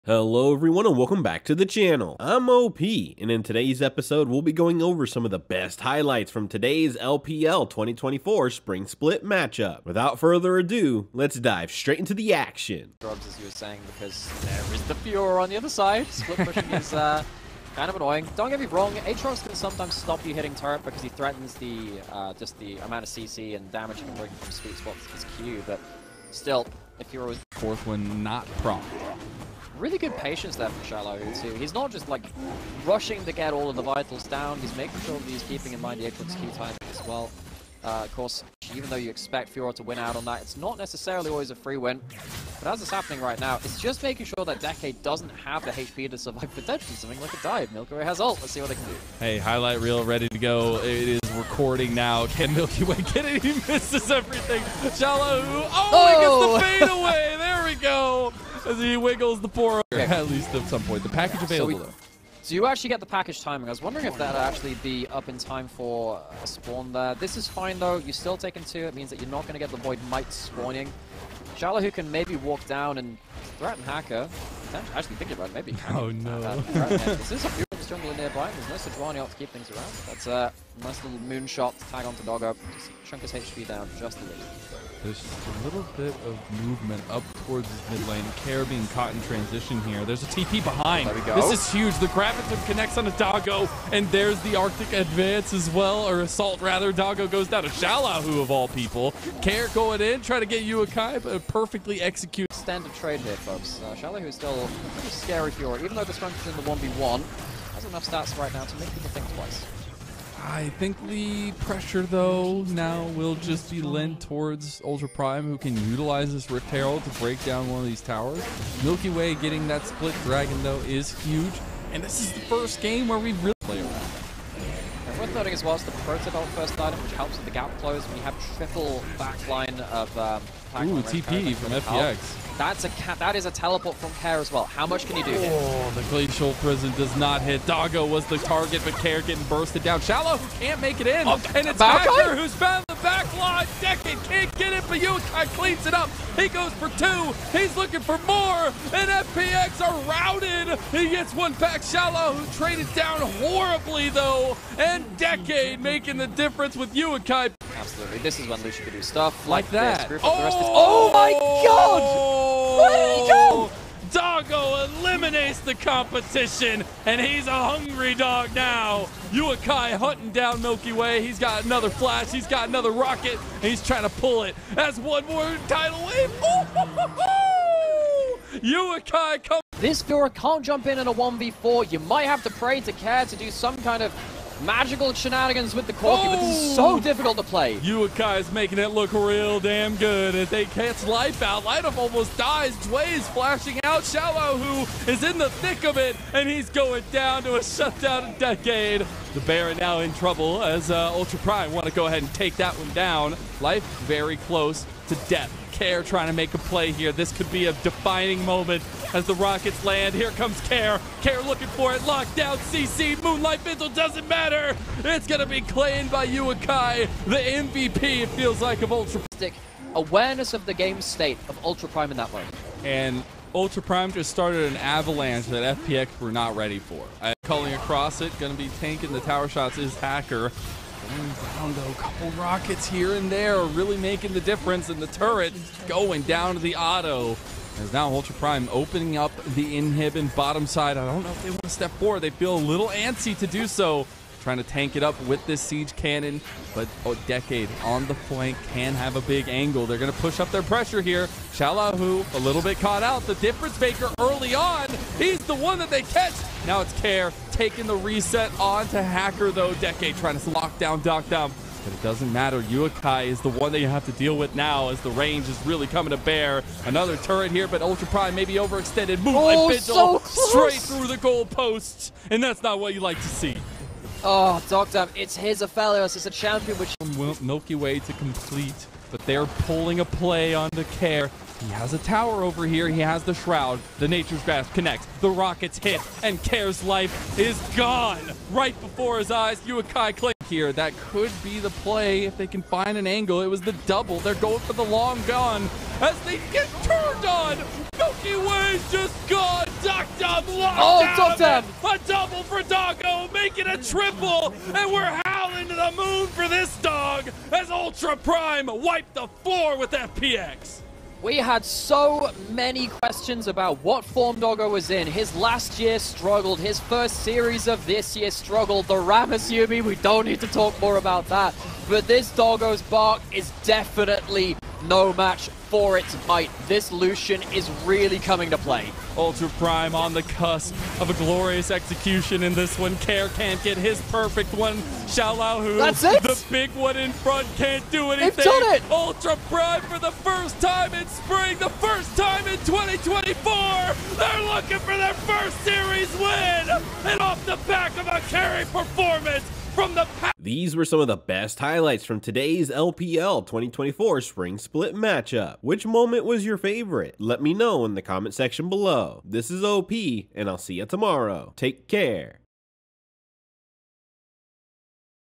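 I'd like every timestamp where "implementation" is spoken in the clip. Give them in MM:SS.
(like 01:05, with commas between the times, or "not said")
not said.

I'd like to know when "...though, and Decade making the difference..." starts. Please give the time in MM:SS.
02:34.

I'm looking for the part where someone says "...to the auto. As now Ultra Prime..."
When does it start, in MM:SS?
03:56.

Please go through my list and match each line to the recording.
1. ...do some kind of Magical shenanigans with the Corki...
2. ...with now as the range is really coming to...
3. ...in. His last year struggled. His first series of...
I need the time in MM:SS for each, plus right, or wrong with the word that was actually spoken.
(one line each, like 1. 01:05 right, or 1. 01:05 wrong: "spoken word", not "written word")
1. 03:03 right
2. 04:24 right
3. 05:14 right.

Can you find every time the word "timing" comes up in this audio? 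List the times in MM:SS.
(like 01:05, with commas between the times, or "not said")
00:36, 01:03.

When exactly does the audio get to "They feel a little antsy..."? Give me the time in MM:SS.
04:02.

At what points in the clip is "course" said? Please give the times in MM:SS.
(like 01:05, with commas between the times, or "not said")
00:38.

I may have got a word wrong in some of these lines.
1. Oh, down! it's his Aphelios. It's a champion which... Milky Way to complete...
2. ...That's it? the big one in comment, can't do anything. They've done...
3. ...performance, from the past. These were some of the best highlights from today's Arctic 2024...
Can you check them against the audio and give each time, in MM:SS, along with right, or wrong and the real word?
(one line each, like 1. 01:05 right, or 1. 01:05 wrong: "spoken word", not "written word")
1. 04:34 right
2. 05:35 wrong: "front", not "comment"
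3. 05:48 wrong: "LPL", not "Arctic".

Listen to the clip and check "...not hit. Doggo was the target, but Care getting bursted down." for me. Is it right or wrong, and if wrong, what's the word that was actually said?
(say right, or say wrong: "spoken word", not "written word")
right.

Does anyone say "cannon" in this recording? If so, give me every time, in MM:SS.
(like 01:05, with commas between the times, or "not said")
04:05.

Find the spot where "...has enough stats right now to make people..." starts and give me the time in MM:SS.
01:47.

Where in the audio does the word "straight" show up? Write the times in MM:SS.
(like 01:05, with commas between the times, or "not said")
00:11, 04:30.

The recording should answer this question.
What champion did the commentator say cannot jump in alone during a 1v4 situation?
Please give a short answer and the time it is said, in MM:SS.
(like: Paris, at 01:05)
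Vira, at 03:00.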